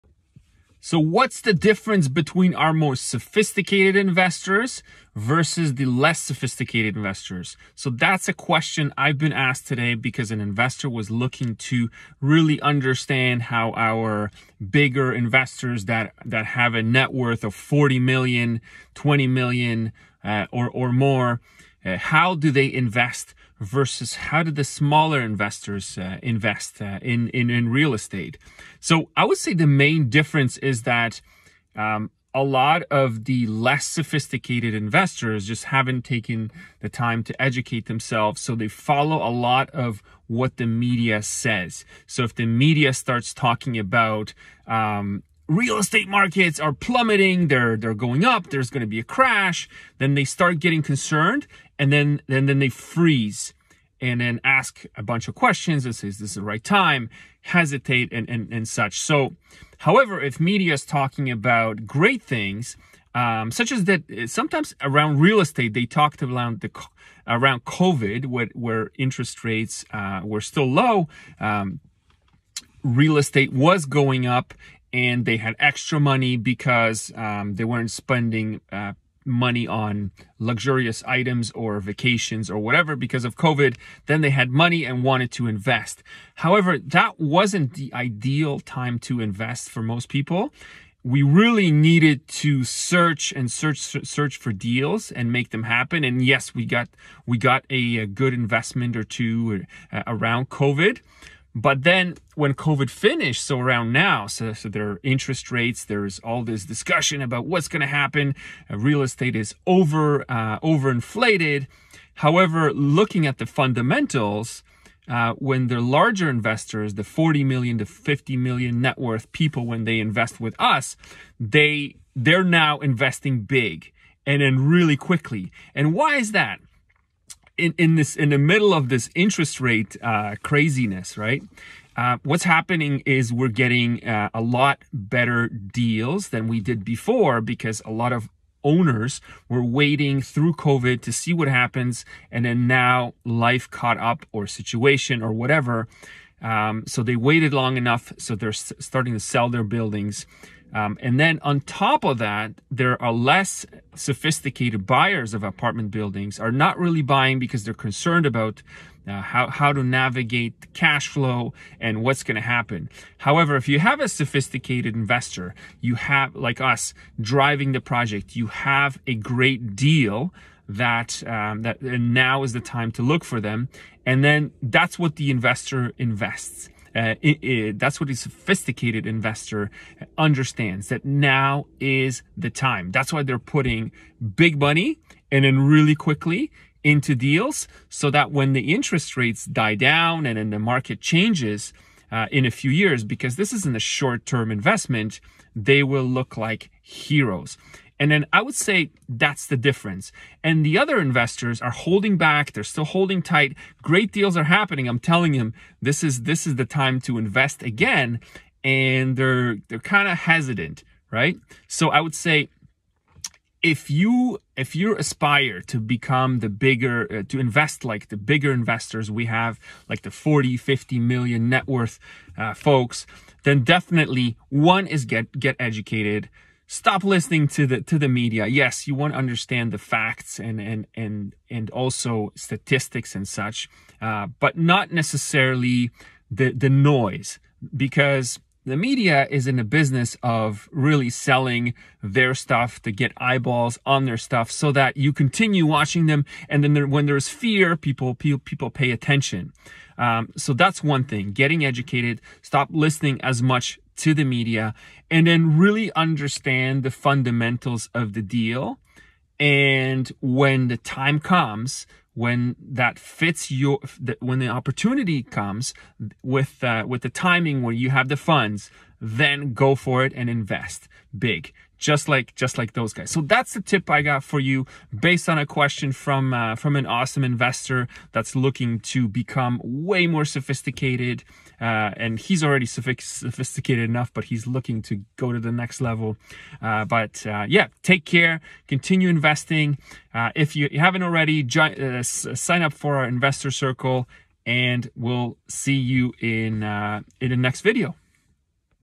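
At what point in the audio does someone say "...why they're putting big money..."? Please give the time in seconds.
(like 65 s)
183 s.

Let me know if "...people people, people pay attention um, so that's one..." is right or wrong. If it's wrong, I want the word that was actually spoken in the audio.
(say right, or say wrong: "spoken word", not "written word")
right.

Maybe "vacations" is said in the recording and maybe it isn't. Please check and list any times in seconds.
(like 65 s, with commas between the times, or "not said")
81 s.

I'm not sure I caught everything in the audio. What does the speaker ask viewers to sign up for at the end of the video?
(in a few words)
investor circle.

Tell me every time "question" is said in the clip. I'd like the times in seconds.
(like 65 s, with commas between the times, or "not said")
8 s, 55 s, 275 s.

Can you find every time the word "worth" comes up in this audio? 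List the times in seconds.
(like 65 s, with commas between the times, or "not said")
17 s, 118 s, 221 s.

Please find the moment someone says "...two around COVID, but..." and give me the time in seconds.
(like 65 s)
99 s.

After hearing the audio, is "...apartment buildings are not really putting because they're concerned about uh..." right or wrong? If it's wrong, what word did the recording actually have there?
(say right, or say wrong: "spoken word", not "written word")
wrong: "buying", not "putting".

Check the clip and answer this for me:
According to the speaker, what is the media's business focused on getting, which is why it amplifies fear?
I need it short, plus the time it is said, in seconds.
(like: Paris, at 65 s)
eyeballs, at 243 s.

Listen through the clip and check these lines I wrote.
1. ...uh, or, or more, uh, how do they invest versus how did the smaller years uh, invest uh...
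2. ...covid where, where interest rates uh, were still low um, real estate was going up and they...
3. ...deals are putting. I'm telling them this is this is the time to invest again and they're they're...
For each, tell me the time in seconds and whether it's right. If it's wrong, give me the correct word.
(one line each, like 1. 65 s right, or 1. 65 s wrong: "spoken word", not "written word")
1. 20 s wrong: "investors", not "years"
2. 67 s right
3. 204 s wrong: "happening", not "putting".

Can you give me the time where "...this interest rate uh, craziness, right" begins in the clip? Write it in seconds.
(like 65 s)
128 s.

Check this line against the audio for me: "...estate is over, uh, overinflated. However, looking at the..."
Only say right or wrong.
right.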